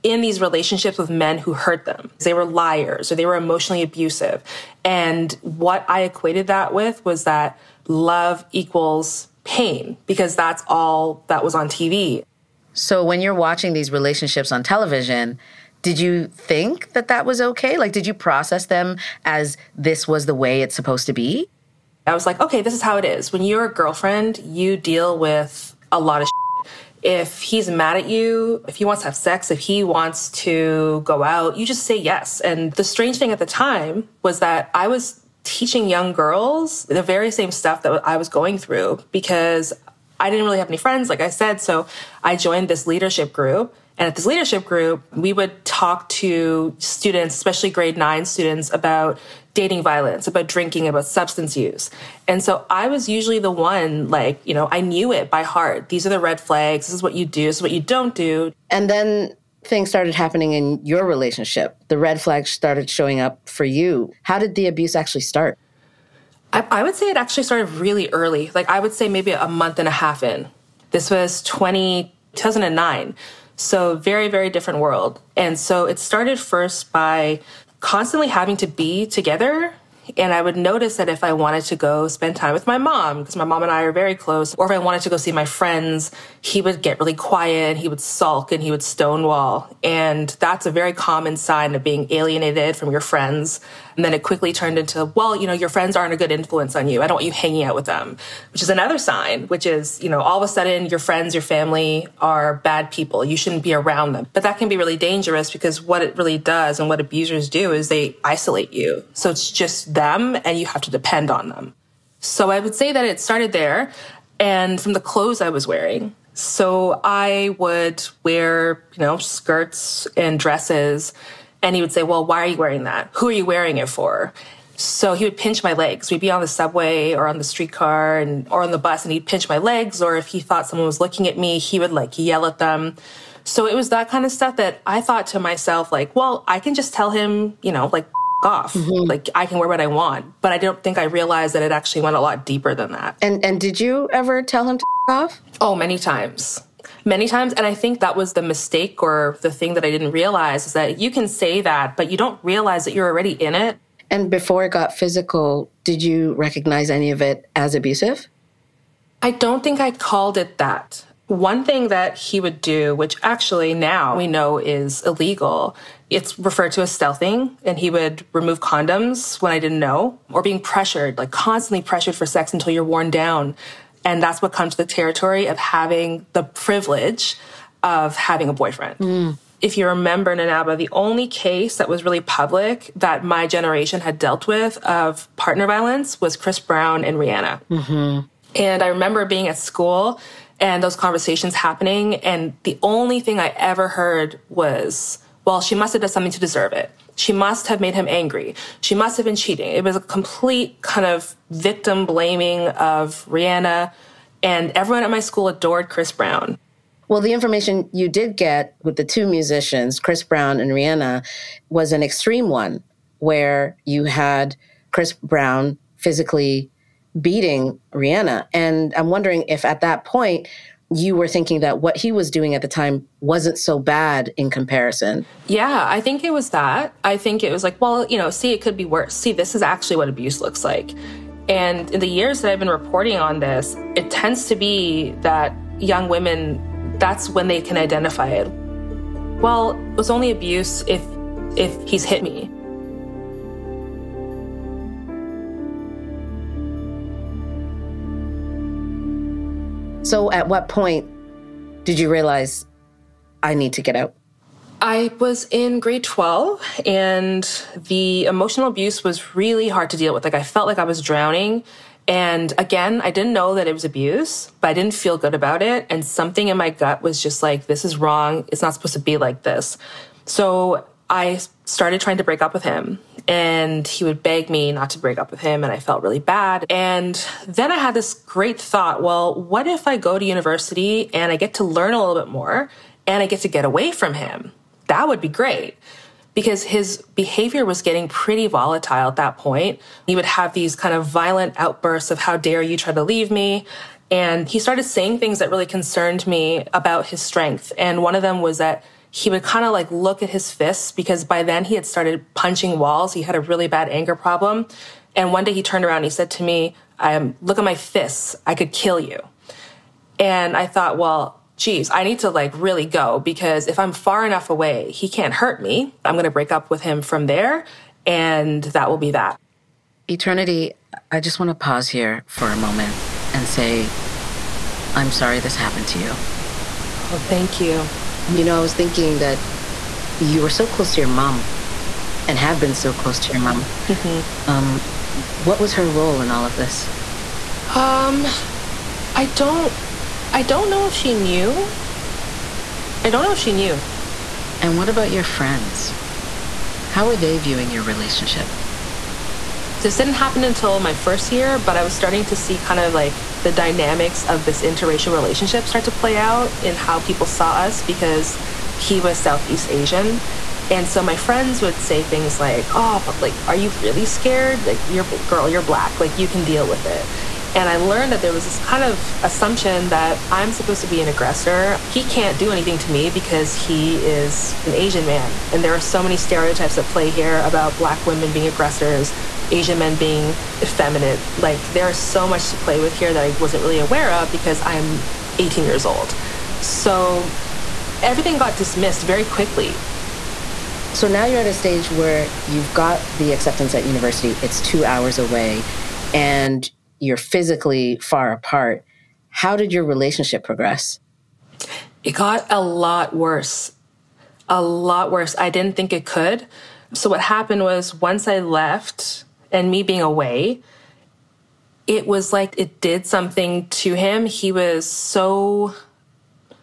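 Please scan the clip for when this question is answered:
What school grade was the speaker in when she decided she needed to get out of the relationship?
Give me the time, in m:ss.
4:15.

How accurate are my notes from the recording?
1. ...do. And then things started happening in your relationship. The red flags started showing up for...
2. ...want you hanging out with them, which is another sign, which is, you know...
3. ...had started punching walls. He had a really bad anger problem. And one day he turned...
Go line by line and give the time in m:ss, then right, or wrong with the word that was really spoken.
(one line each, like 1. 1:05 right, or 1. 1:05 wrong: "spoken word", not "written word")
1. 0:58 right
2. 1:37 right
3. 5:01 right.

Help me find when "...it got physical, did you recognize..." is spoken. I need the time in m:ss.
2:34.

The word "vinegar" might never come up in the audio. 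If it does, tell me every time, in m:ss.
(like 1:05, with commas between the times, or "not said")
not said.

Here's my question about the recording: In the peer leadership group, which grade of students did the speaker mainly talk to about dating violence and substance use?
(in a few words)
Grade 9.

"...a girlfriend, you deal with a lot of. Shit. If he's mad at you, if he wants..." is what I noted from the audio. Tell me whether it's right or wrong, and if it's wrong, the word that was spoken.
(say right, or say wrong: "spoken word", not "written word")
right.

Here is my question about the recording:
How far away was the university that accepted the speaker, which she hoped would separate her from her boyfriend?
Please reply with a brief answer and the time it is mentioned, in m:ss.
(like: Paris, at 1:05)
2 hours, at 6:34.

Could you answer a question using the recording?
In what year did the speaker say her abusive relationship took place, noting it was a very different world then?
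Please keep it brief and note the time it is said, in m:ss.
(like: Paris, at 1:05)
2009, at 1:12.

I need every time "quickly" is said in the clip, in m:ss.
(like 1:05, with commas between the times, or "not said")
1:34, 6:29.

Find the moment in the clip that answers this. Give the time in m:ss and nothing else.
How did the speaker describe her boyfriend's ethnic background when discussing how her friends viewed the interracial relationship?
5:59.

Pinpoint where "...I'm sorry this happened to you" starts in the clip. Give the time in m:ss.
5:24.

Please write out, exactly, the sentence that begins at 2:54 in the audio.
And that's what comes to the territory of having the privilege of having a boyfriend.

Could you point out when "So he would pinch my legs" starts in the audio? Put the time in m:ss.
2:04.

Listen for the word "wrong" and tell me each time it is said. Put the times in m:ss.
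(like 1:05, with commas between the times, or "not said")
4:27.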